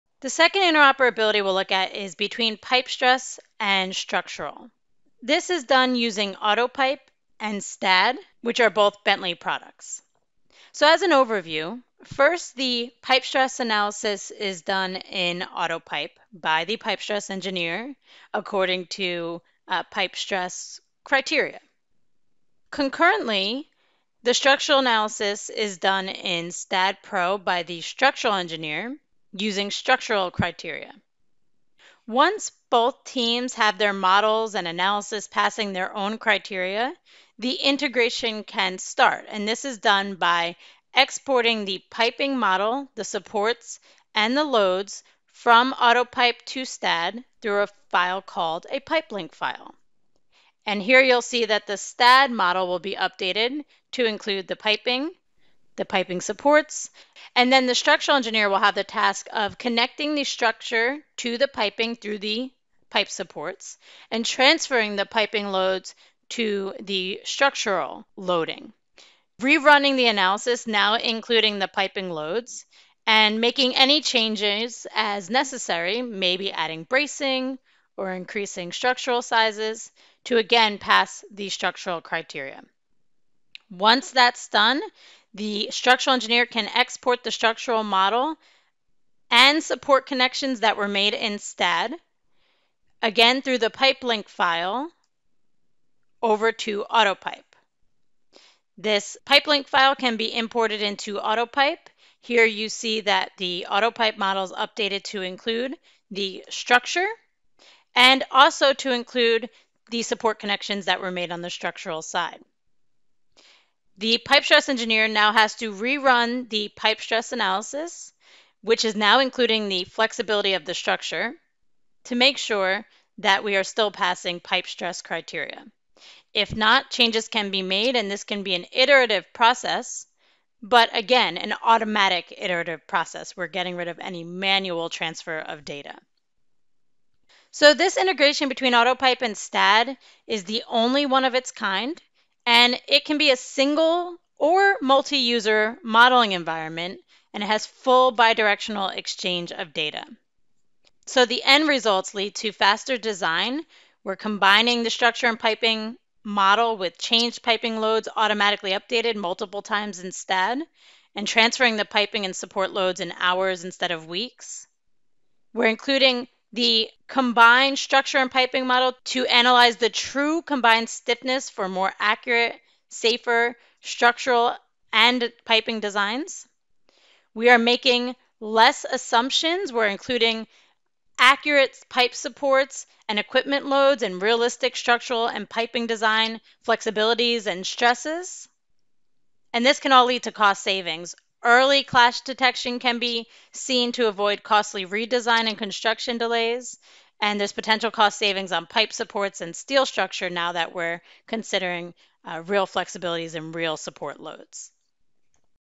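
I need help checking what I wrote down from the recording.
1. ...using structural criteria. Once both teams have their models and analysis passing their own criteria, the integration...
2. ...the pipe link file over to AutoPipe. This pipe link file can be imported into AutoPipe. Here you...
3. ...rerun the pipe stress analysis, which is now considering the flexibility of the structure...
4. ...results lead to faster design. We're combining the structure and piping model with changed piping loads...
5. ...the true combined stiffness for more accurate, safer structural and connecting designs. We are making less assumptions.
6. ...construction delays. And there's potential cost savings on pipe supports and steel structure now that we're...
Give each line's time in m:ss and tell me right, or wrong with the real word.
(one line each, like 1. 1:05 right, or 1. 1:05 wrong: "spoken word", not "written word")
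1. 0:29 right
2. 1:33 right
3. 1:55 wrong: "including", not "considering"
4. 2:31 right
5. 2:49 wrong: "piping", not "connecting"
6. 3:15 right.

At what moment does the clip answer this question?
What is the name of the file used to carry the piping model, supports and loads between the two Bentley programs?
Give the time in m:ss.
0:48.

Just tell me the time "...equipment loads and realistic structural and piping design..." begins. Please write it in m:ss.
3:03.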